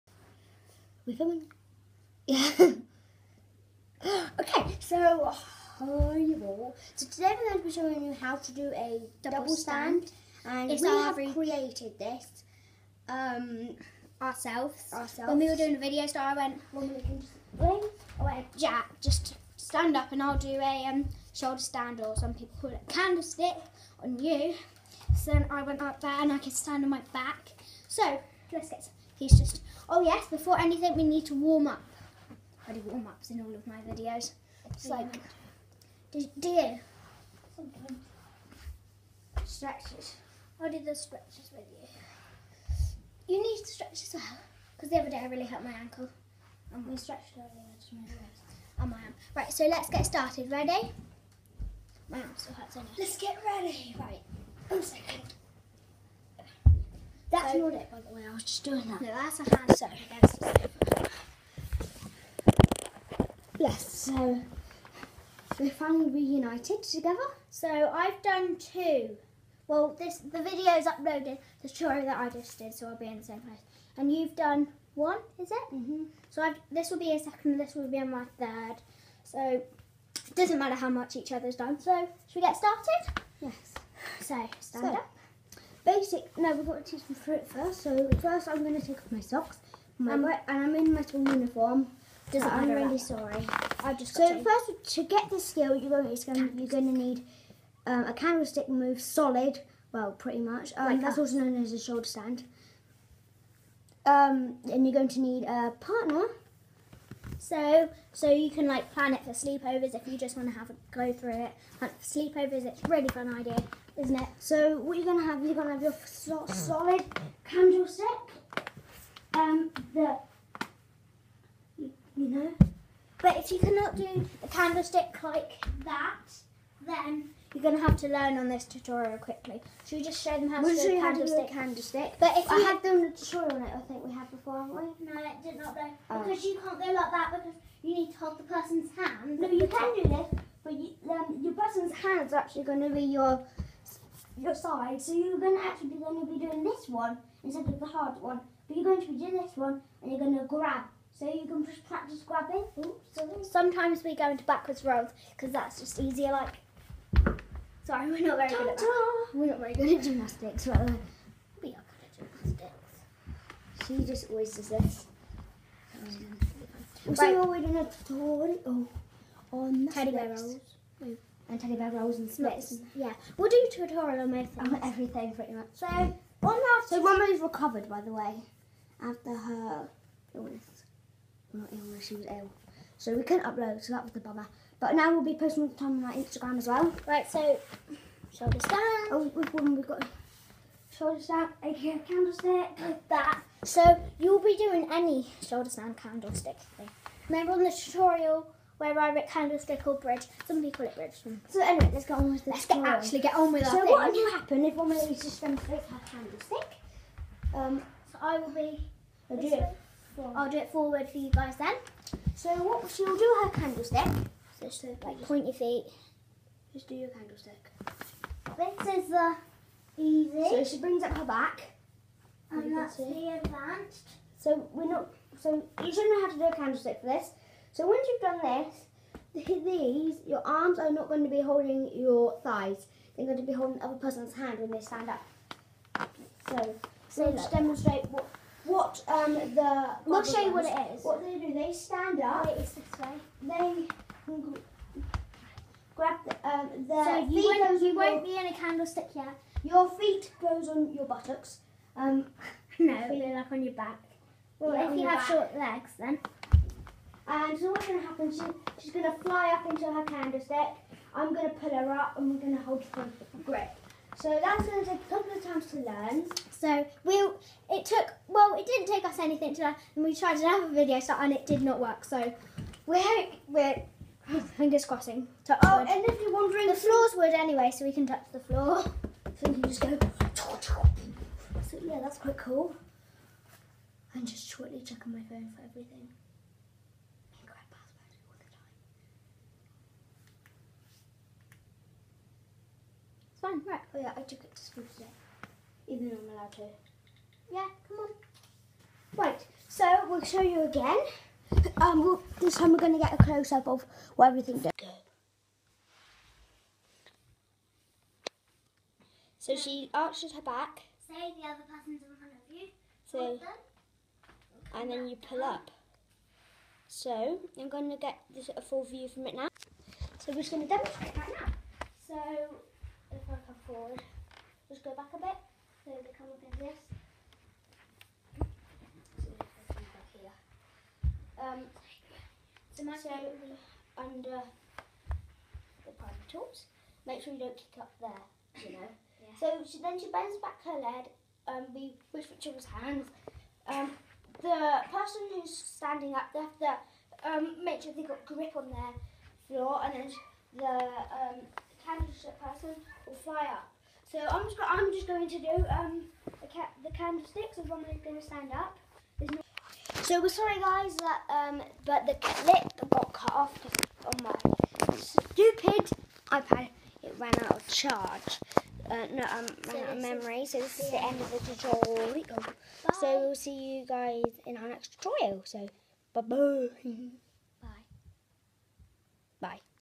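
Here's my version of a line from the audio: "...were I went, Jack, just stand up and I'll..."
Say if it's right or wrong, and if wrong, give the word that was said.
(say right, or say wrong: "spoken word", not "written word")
right.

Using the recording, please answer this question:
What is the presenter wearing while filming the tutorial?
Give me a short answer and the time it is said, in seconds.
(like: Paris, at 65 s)
school uniform, at 91 s.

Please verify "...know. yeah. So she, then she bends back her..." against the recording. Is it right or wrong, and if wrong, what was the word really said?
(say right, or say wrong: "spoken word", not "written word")
right.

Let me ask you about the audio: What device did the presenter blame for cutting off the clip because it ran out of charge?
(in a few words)
iPad.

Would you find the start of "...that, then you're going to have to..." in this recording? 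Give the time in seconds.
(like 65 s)
125 s.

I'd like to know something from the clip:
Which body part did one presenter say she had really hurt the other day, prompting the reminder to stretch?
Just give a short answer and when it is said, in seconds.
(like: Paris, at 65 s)
ankle, at 45 s.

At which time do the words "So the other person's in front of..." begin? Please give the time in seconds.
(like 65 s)
311 s.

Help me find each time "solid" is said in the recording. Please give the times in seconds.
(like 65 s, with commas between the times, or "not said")
99 s, 116 s.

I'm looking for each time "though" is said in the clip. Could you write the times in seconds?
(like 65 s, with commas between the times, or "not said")
135 s, 296 s.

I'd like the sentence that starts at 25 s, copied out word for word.
So then I went up there and I can stand on my back.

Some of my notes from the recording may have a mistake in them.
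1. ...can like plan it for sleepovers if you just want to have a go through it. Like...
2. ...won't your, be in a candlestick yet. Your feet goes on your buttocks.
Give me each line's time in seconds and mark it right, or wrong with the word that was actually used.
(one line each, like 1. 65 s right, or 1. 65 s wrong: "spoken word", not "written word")
1. 108 s right
2. 247 s right.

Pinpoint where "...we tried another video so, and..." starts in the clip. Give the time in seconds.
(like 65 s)
270 s.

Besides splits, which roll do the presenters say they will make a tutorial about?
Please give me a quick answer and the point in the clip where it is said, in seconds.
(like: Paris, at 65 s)
teddy bear rolls, at 169 s.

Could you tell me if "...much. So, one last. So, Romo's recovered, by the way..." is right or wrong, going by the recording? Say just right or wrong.
right.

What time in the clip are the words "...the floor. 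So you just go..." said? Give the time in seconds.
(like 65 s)
278 s.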